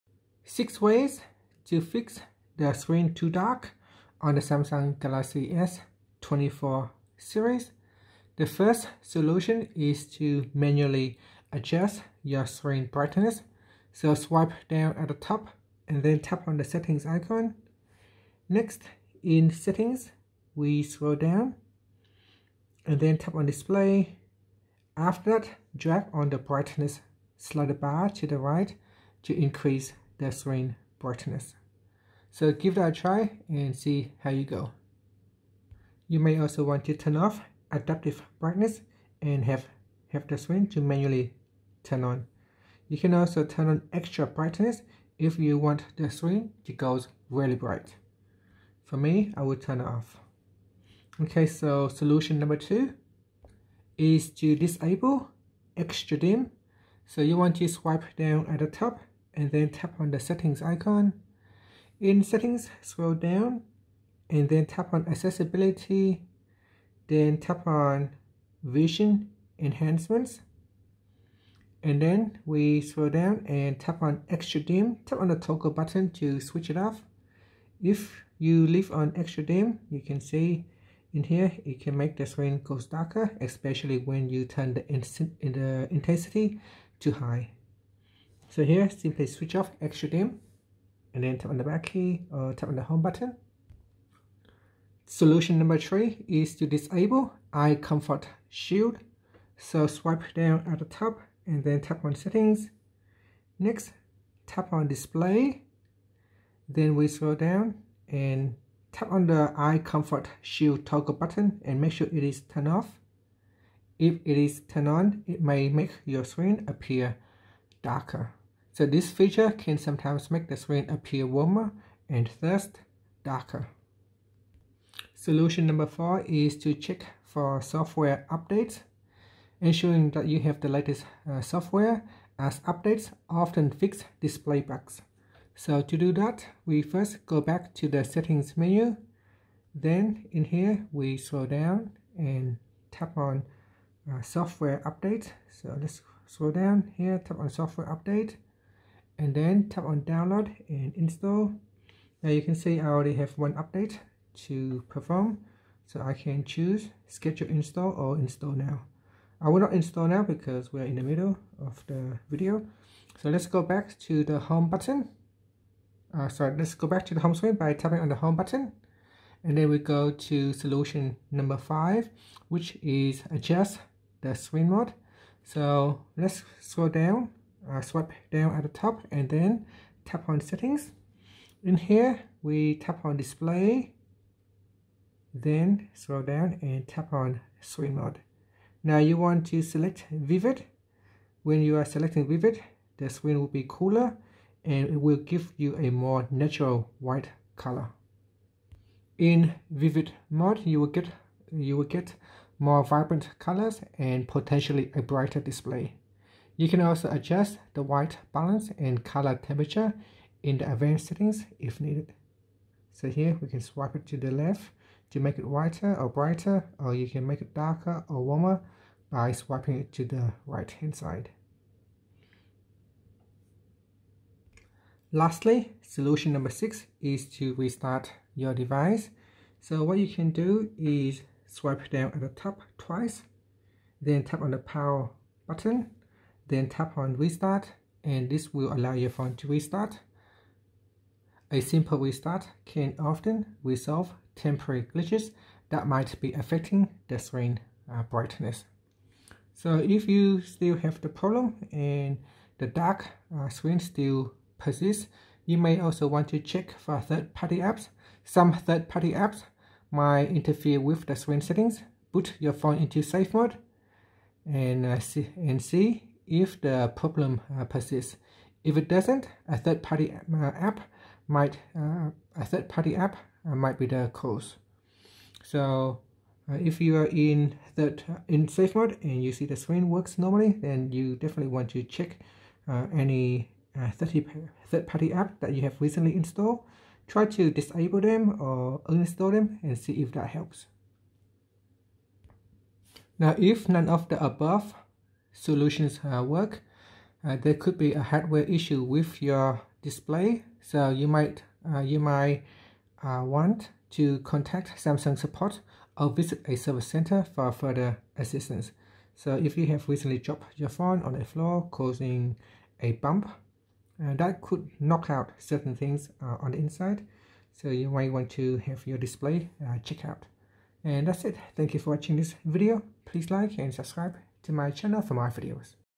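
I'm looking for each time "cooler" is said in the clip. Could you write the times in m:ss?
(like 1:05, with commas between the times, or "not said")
3:13.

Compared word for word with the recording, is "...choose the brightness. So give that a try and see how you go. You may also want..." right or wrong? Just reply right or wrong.
wrong.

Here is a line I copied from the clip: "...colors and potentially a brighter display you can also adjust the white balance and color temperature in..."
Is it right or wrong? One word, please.
right.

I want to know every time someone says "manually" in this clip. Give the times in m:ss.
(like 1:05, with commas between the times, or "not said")
0:10, 0:40.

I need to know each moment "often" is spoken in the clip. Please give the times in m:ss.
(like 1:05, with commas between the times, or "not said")
2:13, 4:02.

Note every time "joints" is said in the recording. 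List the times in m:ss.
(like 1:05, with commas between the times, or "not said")
not said.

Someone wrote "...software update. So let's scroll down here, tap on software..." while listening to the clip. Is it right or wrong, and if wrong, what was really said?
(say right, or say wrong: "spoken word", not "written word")
right.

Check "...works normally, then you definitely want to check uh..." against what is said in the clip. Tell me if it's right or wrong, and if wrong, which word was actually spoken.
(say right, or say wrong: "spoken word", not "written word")
right.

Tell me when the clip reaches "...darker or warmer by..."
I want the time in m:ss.
3:37.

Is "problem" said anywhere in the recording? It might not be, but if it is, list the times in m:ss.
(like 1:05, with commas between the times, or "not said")
4:11, 4:26.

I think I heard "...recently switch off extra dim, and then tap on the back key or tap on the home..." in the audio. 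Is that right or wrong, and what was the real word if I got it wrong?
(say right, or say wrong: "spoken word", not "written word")
wrong: "simply", not "recently".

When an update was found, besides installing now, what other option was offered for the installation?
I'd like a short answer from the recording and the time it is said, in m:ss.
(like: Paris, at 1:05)
Schedule install, at 2:37.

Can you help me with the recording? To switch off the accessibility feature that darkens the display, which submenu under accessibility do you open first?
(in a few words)
Vision enhancements.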